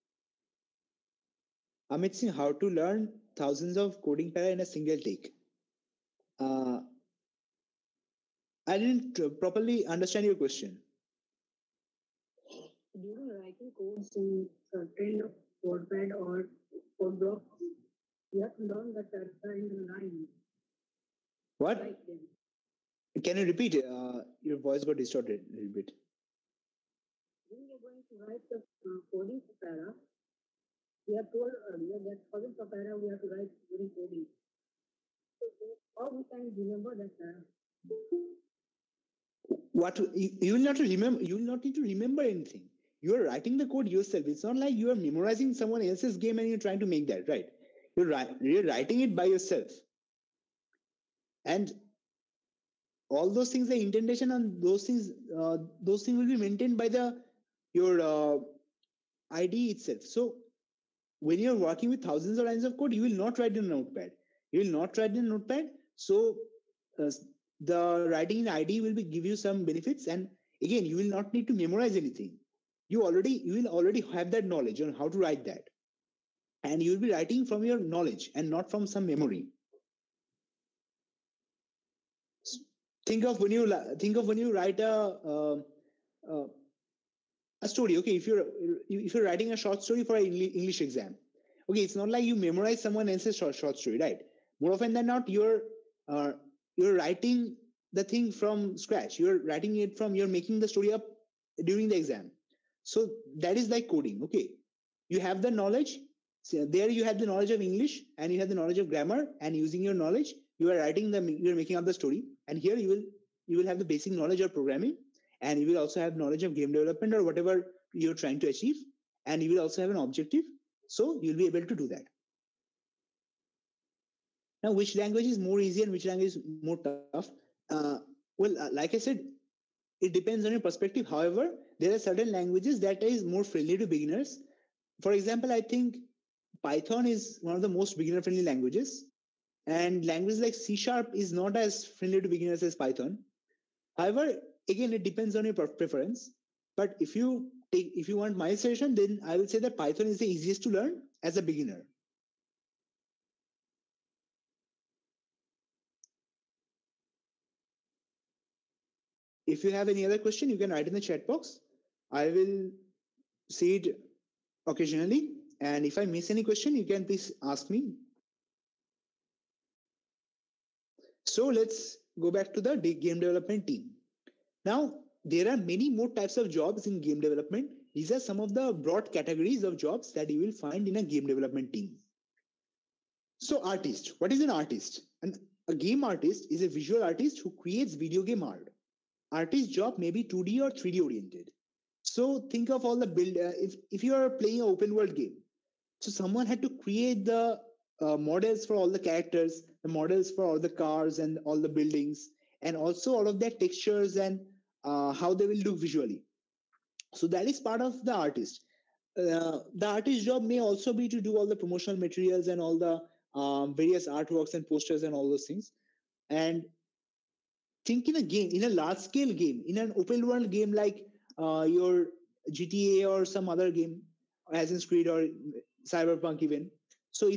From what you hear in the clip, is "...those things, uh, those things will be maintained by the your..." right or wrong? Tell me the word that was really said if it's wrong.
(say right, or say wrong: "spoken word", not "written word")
right.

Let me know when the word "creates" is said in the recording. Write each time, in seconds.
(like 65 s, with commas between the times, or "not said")
187 s, 196 s.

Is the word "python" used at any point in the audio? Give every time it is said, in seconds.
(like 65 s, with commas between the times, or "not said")
136 s, 142 s, 149 s.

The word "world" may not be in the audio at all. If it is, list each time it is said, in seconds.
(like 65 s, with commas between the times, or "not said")
194 s, 220 s.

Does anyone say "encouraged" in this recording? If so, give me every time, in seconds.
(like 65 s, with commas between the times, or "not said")
not said.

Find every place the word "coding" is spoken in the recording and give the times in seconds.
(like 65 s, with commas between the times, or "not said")
4 s, 29 s, 33 s, 103 s.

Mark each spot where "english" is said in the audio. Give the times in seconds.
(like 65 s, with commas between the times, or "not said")
90 s, 107 s.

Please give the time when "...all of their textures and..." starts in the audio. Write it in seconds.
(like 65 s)
203 s.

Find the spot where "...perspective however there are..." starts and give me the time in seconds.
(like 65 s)
130 s.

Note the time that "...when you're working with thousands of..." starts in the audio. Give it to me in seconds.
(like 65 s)
61 s.